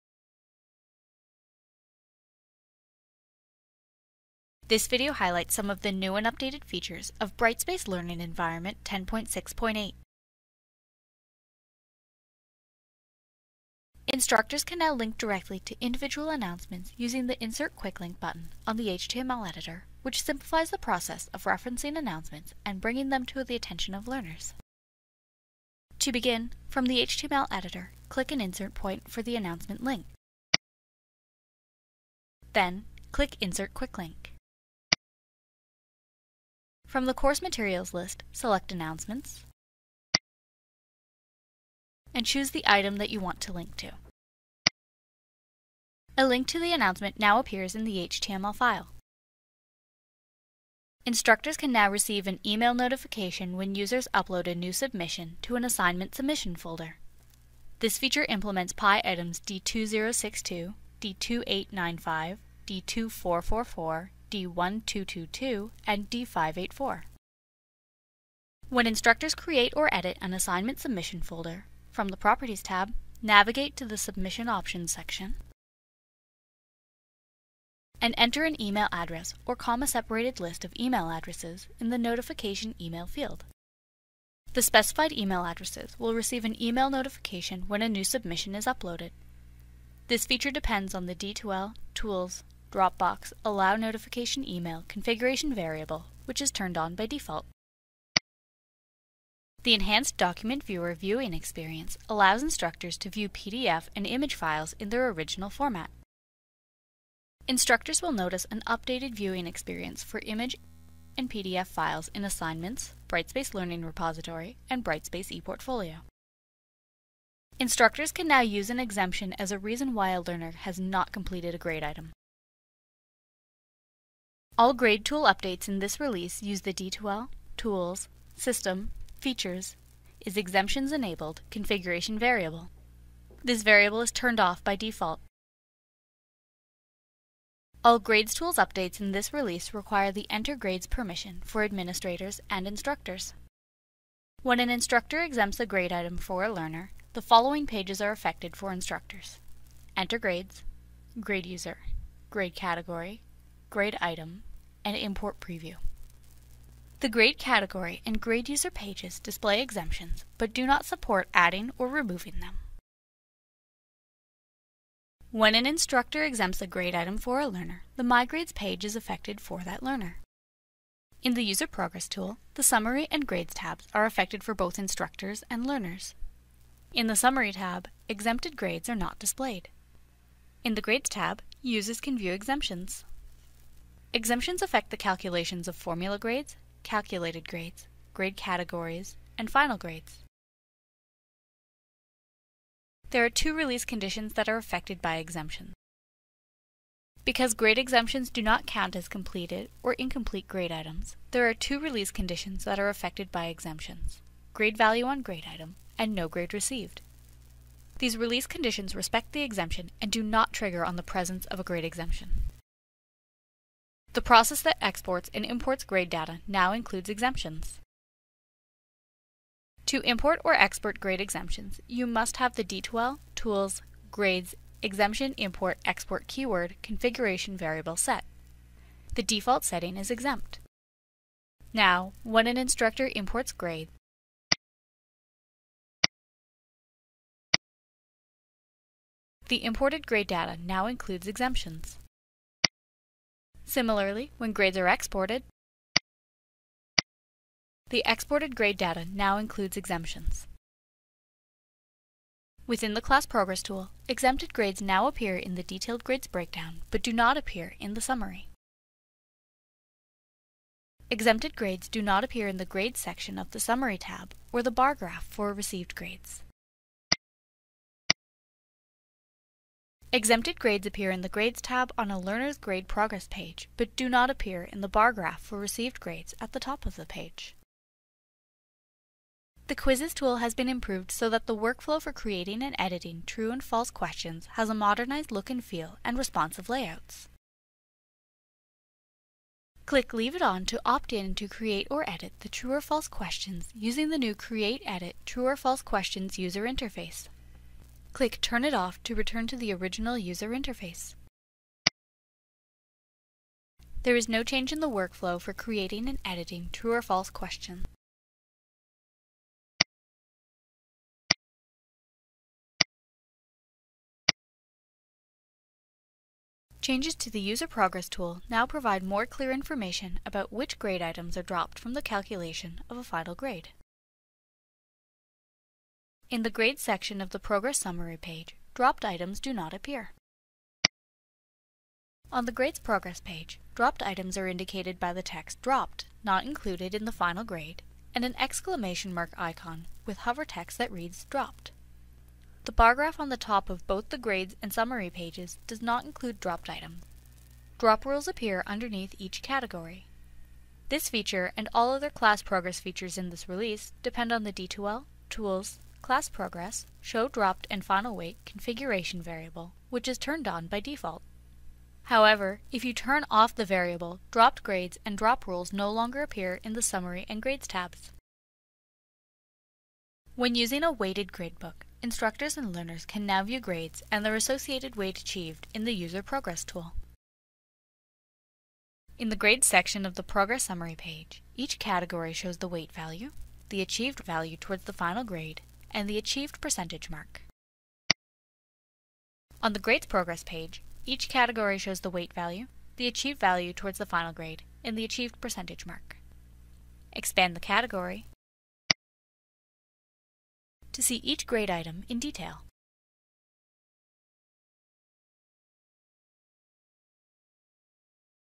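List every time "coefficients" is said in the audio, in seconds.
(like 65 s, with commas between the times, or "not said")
not said.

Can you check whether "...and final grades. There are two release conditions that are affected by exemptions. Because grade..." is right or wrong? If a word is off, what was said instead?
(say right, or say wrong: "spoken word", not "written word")
right.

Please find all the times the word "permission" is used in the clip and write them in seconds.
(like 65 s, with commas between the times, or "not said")
140 s.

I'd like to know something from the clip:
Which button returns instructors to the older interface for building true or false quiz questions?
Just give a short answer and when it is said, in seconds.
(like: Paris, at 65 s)
Turn it off, at 298 s.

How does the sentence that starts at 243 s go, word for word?
Similarly, when grades are exported, the exported grade data now includes exemptions.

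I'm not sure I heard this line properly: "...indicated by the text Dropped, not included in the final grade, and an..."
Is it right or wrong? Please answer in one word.
right.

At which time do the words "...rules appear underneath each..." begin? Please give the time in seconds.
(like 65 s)
348 s.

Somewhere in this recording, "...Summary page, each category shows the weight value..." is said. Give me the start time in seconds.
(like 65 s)
380 s.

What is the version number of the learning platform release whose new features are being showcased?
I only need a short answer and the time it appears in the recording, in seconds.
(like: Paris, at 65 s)
10.6.8, at 8 s.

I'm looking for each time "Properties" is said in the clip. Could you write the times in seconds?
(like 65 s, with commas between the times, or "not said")
72 s.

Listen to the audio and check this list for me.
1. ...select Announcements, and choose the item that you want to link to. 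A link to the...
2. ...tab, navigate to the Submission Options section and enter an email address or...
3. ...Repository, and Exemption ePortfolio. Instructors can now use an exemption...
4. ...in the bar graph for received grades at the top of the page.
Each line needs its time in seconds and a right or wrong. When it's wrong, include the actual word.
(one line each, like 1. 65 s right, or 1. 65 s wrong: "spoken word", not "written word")
1. 38 s right
2. 72 s right
3. 113 s wrong: "Brightspace", not "Exemption"
4. 274 s right.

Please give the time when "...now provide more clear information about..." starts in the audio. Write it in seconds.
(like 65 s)
318 s.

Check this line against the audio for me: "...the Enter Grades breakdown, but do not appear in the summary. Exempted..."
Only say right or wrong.
wrong.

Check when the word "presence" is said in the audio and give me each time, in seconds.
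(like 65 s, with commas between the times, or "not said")
211 s.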